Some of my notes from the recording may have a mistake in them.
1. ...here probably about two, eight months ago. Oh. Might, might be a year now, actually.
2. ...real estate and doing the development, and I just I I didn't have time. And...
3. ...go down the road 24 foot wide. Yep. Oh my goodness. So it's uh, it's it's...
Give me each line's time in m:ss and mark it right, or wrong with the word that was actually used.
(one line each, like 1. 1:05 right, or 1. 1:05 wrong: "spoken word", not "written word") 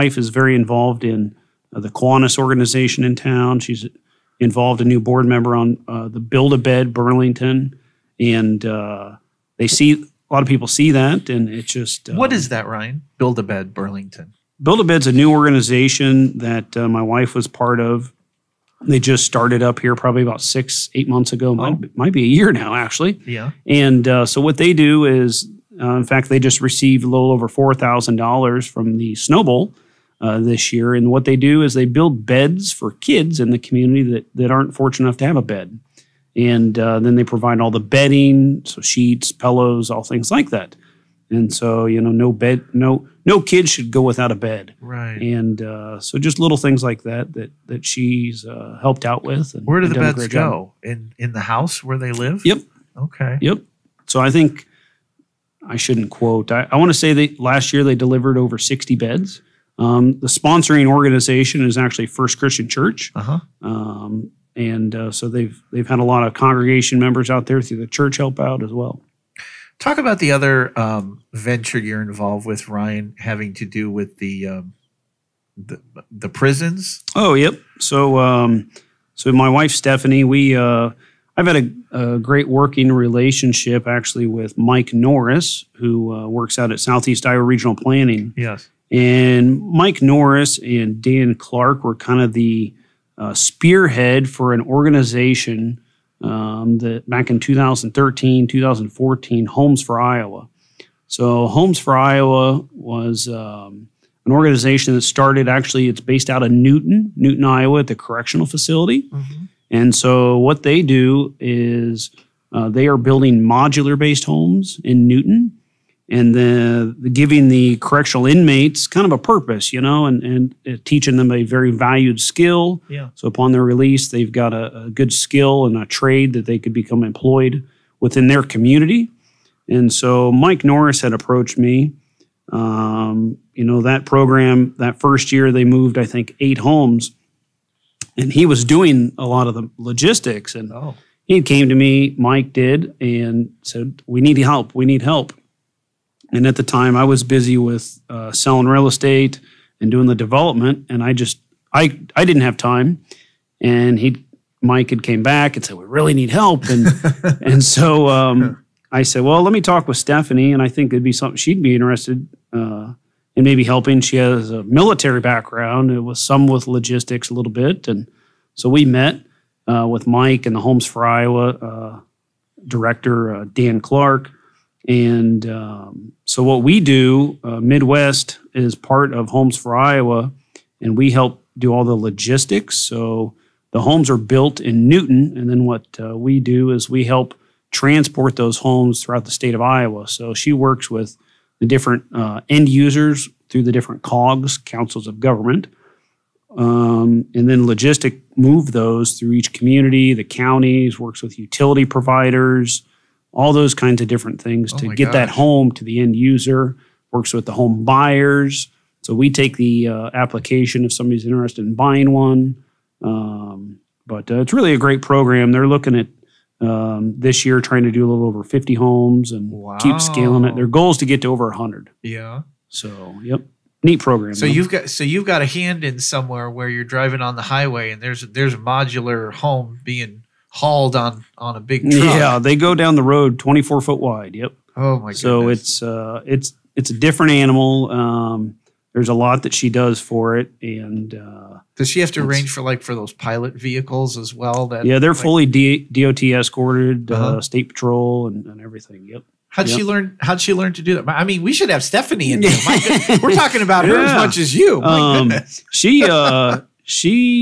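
1. 0:19 wrong: "six", not "two"
2. 2:28 right
3. 3:52 right.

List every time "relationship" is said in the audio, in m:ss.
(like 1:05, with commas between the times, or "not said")
1:22.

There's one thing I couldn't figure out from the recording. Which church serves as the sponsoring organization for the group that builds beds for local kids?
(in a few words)
First Christian Church.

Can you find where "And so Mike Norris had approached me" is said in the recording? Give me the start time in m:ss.
2:09.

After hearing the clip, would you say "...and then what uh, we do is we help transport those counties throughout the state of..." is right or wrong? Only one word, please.
wrong.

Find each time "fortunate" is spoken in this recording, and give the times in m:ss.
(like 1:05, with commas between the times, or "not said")
0:34.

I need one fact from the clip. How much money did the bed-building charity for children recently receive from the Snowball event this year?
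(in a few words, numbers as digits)
Over $4,000.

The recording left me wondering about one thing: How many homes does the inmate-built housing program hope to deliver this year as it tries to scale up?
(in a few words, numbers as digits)
A little over 50.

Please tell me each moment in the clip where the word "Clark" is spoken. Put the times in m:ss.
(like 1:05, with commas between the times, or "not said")
1:31, 2:53.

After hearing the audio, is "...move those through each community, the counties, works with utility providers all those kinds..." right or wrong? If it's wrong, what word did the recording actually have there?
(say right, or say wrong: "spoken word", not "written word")
right.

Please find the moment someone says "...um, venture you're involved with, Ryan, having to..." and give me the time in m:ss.
1:10.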